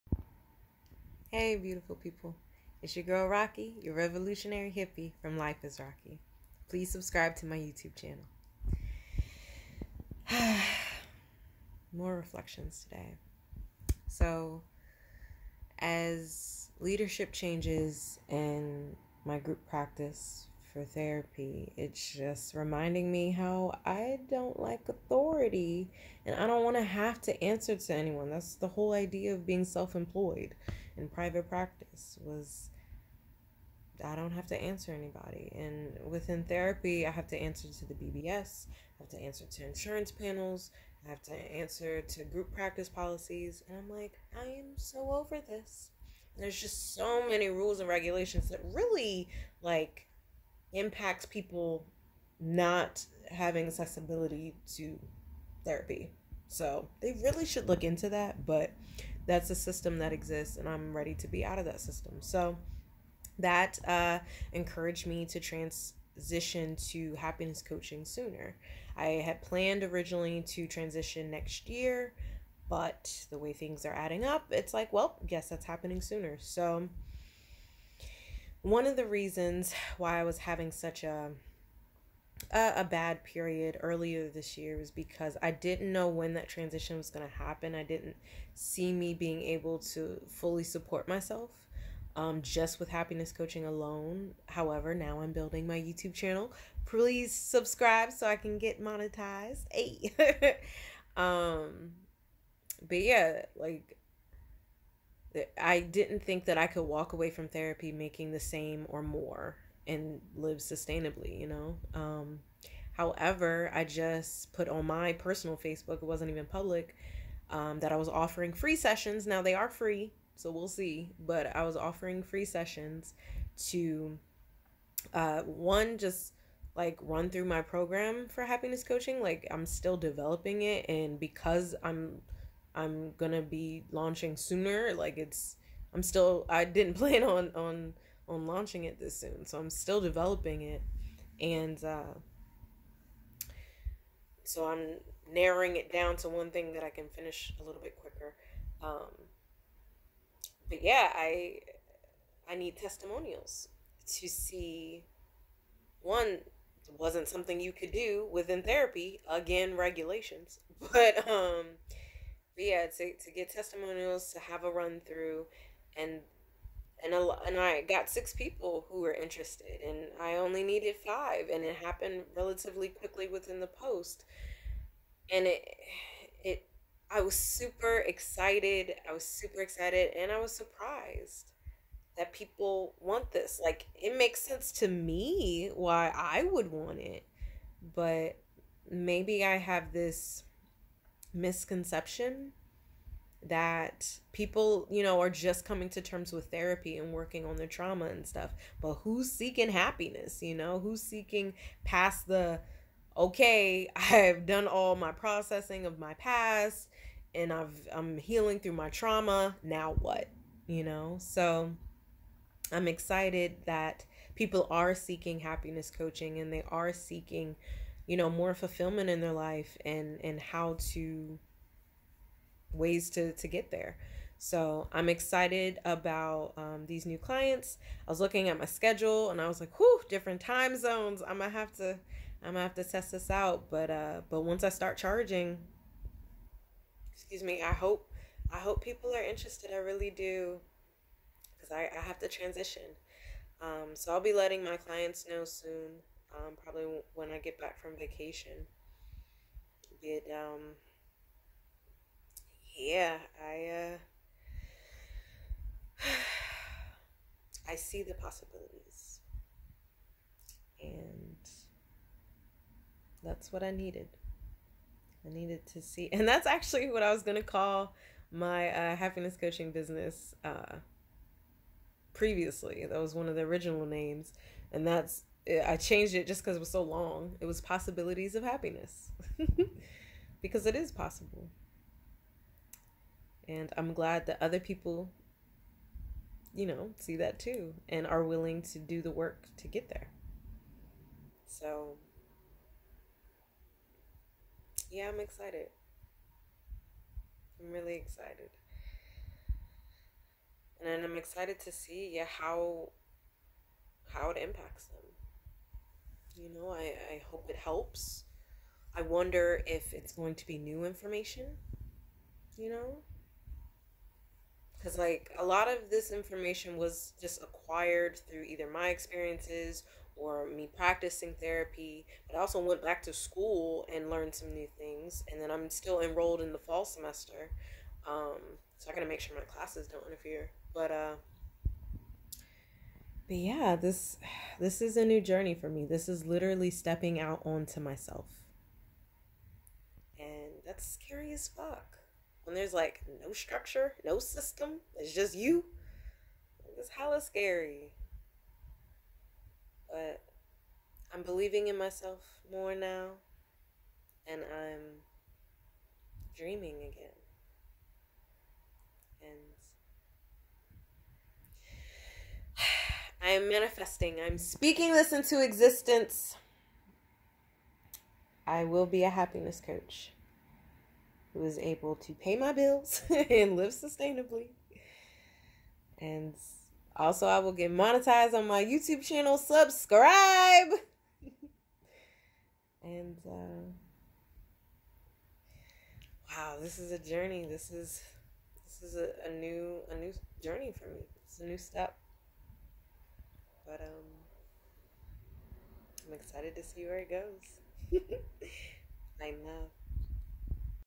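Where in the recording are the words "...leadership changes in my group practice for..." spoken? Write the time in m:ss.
0:16.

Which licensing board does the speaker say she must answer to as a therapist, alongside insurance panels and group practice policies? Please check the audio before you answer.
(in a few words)
BBS.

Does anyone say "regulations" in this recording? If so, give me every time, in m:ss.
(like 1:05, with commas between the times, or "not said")
0:47, 2:39.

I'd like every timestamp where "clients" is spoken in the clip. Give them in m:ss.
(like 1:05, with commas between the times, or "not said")
3:47, 4:04.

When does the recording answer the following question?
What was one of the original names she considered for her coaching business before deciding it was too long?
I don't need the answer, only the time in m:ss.
4:37.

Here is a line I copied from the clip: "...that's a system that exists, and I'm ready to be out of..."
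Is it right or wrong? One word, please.
right.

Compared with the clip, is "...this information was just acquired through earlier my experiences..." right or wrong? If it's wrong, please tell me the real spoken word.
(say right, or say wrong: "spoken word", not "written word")
wrong: "either", not "earlier".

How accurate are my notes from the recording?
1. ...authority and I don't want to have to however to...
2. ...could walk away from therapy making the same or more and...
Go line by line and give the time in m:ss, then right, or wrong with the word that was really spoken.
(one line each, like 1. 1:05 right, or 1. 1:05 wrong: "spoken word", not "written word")
1. 0:24 wrong: "answer", not "however"
2. 1:46 right.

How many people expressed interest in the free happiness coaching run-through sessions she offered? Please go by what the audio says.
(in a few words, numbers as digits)
6.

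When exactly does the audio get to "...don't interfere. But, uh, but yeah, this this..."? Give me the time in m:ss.
5:29.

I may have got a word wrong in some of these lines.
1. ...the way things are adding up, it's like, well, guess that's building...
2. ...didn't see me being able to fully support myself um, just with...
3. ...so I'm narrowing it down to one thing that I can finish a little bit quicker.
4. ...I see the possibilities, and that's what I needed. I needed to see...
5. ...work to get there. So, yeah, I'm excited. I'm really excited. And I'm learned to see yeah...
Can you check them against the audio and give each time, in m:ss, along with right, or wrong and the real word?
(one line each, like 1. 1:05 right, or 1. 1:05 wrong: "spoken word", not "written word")
1. 1:13 wrong: "happening", not "building"
2. 1:27 right
3. 2:24 right
4. 4:17 right
5. 4:49 wrong: "excited", not "learned".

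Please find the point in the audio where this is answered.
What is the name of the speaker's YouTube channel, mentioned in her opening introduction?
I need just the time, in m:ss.
0:05.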